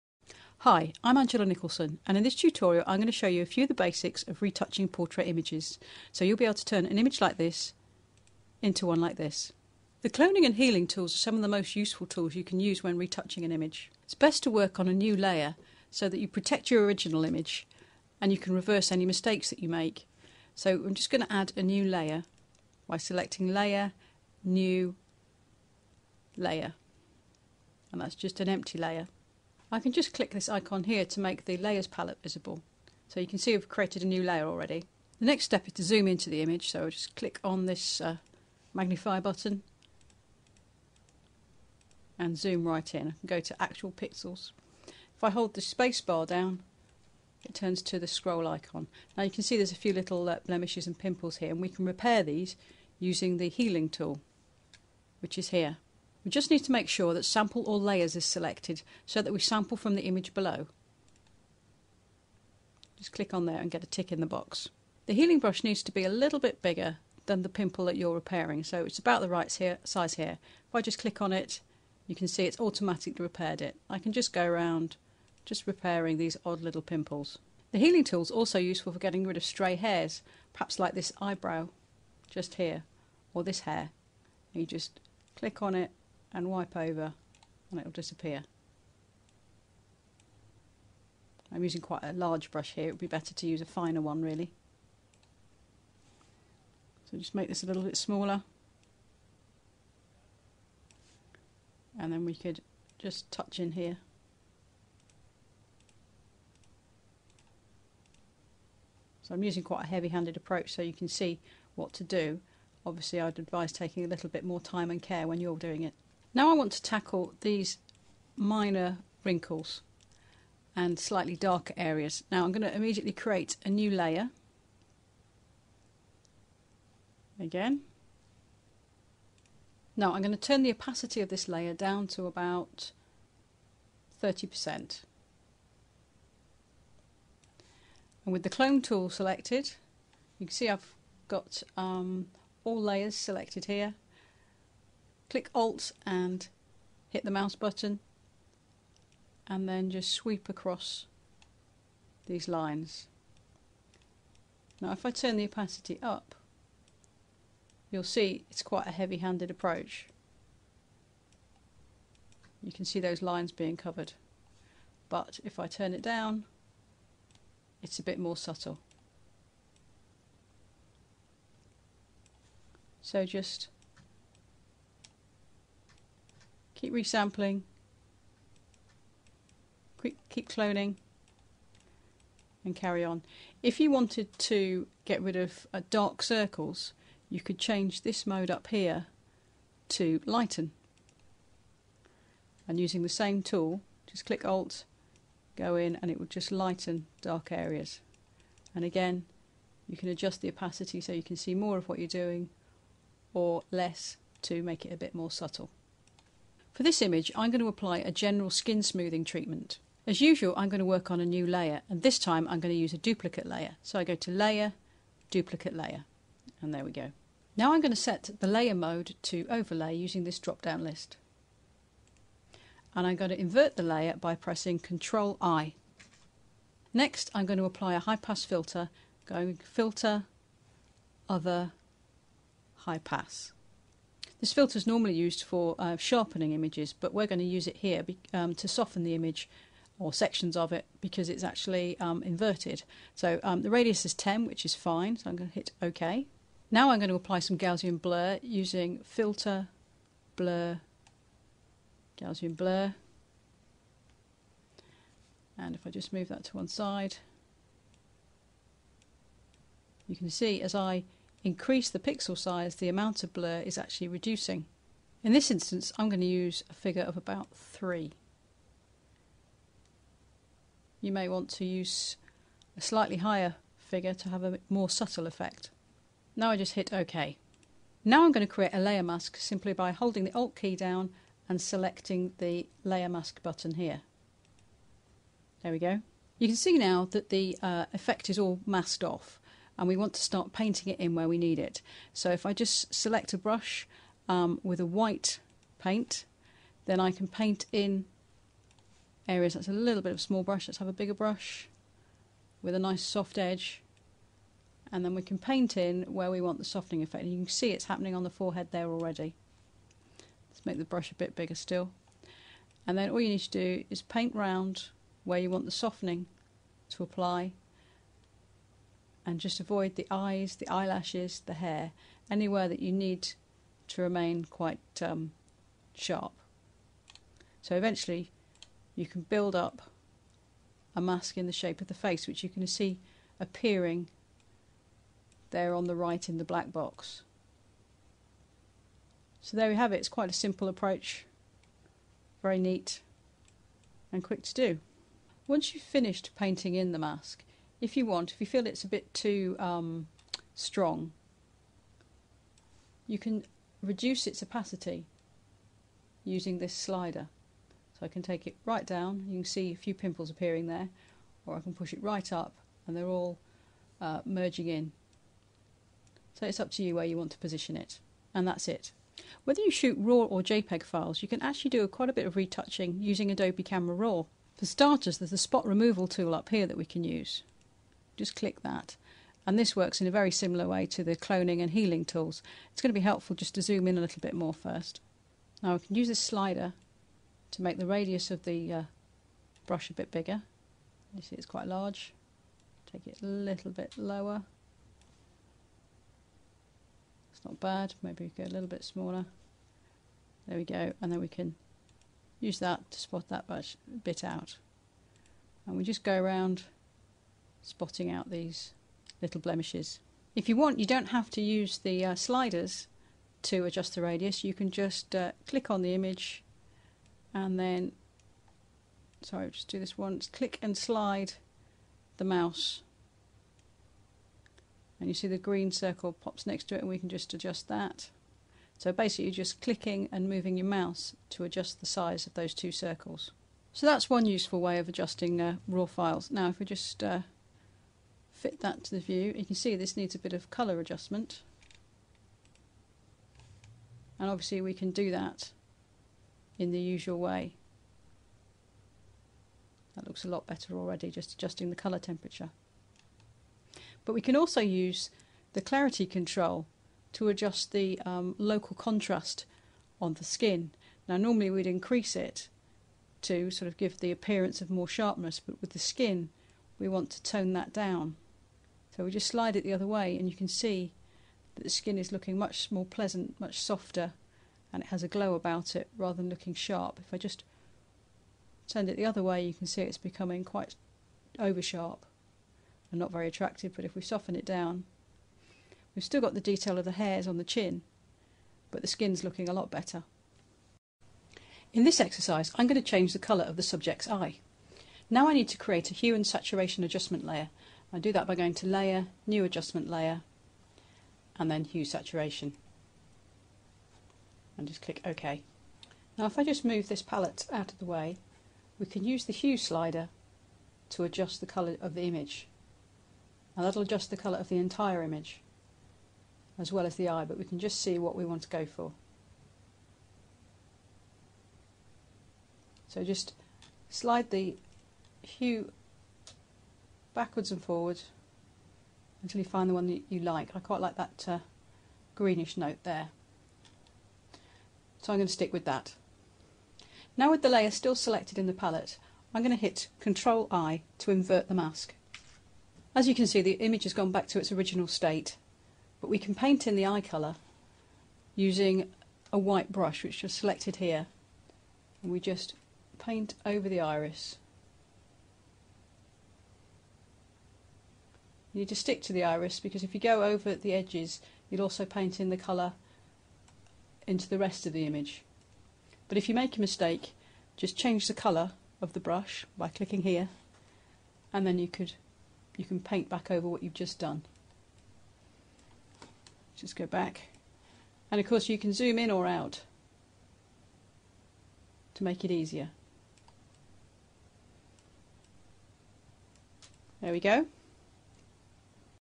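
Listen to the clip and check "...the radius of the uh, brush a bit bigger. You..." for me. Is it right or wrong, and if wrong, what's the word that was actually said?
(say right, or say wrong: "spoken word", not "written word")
right.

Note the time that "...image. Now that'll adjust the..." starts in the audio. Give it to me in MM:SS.
08:32.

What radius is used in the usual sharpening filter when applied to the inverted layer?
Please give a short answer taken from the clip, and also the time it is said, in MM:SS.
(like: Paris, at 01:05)
10, at 04:04.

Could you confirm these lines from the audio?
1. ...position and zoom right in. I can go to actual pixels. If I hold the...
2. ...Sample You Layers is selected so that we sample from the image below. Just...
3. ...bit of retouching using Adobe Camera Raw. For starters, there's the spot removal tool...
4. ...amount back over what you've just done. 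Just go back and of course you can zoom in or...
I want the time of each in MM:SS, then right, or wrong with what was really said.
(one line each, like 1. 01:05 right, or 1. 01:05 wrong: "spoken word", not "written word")
1. 00:39 wrong: "button", not "position"
2. 00:57 wrong: "All", not "You"
3. 06:12 right
4. 09:32 wrong: "paint", not "amount".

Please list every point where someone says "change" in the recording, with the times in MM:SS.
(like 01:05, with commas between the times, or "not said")
03:07, 08:12, 09:27.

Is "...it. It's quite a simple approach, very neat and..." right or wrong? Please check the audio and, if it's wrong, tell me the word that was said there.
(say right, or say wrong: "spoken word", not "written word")
right.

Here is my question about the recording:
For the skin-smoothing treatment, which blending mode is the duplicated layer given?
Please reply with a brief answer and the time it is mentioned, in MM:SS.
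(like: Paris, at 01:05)
Overlay, at 03:39.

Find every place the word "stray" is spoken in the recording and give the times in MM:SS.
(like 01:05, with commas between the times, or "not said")
01:19.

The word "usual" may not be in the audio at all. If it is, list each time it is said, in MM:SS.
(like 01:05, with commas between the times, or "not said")
03:30, 07:26.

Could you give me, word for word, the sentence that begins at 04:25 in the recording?
In this instance, I'm going to use a figure of about 3.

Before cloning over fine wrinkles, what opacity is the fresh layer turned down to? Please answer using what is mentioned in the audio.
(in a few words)
30%.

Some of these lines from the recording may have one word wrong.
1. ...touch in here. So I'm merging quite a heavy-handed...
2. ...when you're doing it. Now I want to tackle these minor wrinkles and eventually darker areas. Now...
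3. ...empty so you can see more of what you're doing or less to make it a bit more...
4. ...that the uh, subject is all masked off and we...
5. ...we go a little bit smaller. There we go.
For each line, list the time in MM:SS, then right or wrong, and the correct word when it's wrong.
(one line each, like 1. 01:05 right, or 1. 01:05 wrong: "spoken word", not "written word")
1. 01:43 wrong: "using", not "merging"
2. 01:55 wrong: "slightly", not "eventually"
3. 03:20 wrong: "opacity", not "empty"
4. 04:47 wrong: "effect", not "subject"
5. 06:38 right.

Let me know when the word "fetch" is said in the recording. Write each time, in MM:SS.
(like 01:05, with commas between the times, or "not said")
not said.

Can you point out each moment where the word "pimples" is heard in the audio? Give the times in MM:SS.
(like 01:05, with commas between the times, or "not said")
00:50, 01:07, 01:16, 05:59.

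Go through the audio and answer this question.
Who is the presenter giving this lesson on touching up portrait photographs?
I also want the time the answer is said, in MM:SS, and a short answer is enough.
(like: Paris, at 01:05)
Angela Nicholson, at 00:01.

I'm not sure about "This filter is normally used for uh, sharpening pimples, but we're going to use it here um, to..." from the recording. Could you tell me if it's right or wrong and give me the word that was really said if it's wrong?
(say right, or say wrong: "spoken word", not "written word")
wrong: "images", not "pimples".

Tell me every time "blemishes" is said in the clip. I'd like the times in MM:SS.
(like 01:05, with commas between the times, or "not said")
00:50, 06:49.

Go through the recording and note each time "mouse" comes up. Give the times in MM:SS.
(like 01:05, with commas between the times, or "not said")
02:27, 07:02, 07:10.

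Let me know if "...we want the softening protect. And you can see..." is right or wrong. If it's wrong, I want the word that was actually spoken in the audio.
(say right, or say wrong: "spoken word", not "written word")
wrong: "effect", not "protect".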